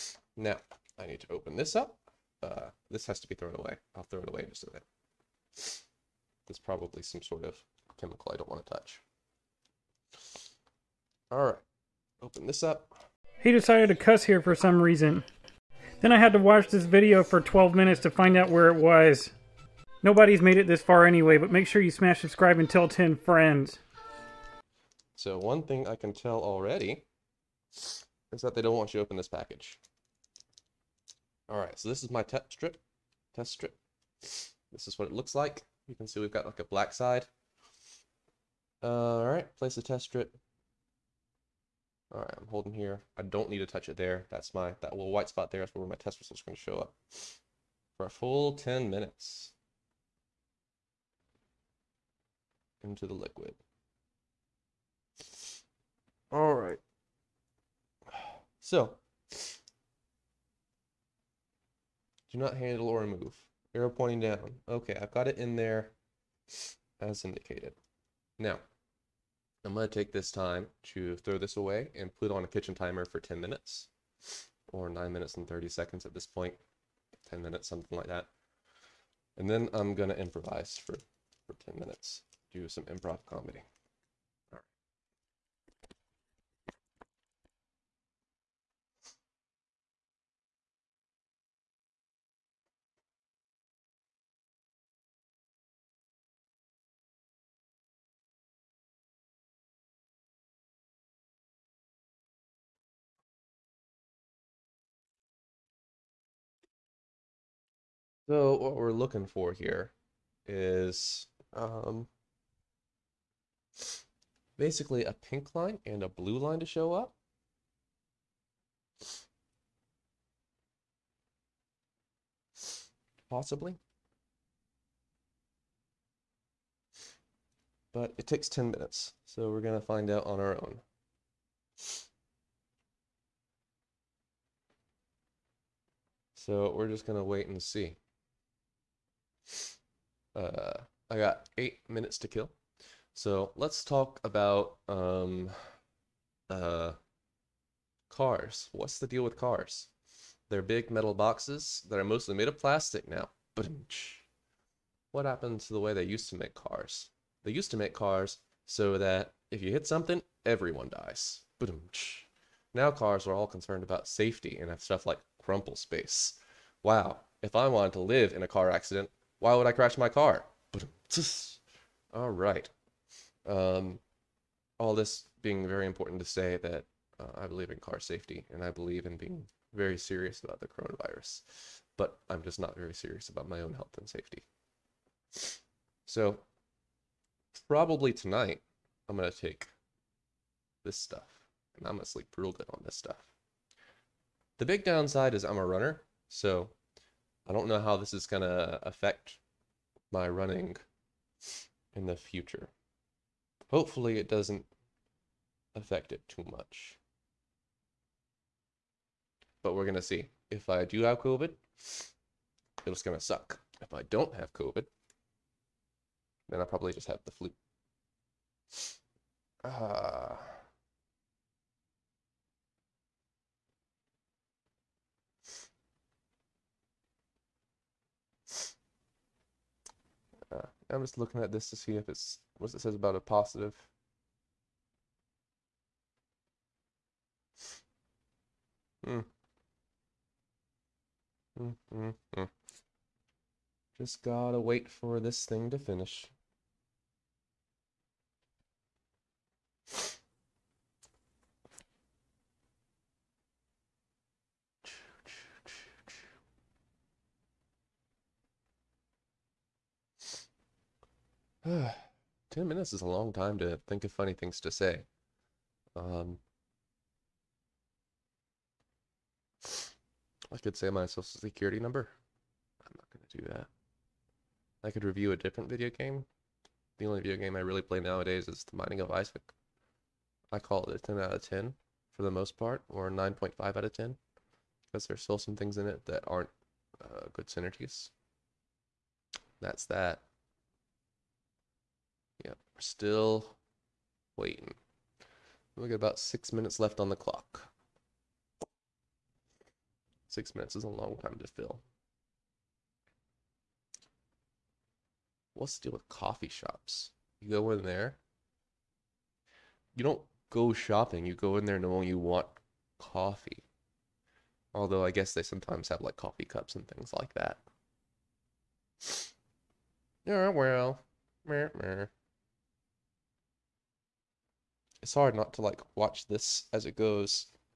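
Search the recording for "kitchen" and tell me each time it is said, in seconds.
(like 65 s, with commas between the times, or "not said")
72 s.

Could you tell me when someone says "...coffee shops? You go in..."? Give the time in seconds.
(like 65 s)
306 s.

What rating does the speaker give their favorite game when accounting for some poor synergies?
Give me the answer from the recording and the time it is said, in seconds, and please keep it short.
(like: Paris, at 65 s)
9.5 out of 10, at 283 s.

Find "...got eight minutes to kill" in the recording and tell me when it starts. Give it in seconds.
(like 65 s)
141 s.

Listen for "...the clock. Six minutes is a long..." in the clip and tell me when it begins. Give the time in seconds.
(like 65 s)
297 s.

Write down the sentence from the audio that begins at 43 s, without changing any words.
I don't need to touch it there.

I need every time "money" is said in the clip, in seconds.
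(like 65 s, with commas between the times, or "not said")
not said.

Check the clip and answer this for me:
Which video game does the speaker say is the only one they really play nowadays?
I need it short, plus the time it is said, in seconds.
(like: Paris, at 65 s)
The Binding of Isaac, at 278 s.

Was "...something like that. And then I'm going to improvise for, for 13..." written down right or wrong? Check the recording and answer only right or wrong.
wrong.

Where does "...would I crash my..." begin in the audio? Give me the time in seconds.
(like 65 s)
169 s.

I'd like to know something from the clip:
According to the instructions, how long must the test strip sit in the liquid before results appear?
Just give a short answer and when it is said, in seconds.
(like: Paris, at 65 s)
10 minutes, at 48 s.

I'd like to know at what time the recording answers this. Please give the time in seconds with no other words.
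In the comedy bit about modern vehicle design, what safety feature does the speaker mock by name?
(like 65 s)
165 s.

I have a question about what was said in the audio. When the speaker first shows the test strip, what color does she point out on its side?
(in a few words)
Black.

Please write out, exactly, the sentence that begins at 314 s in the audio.
Although I guess they sometimes have like coffee cups and things like that.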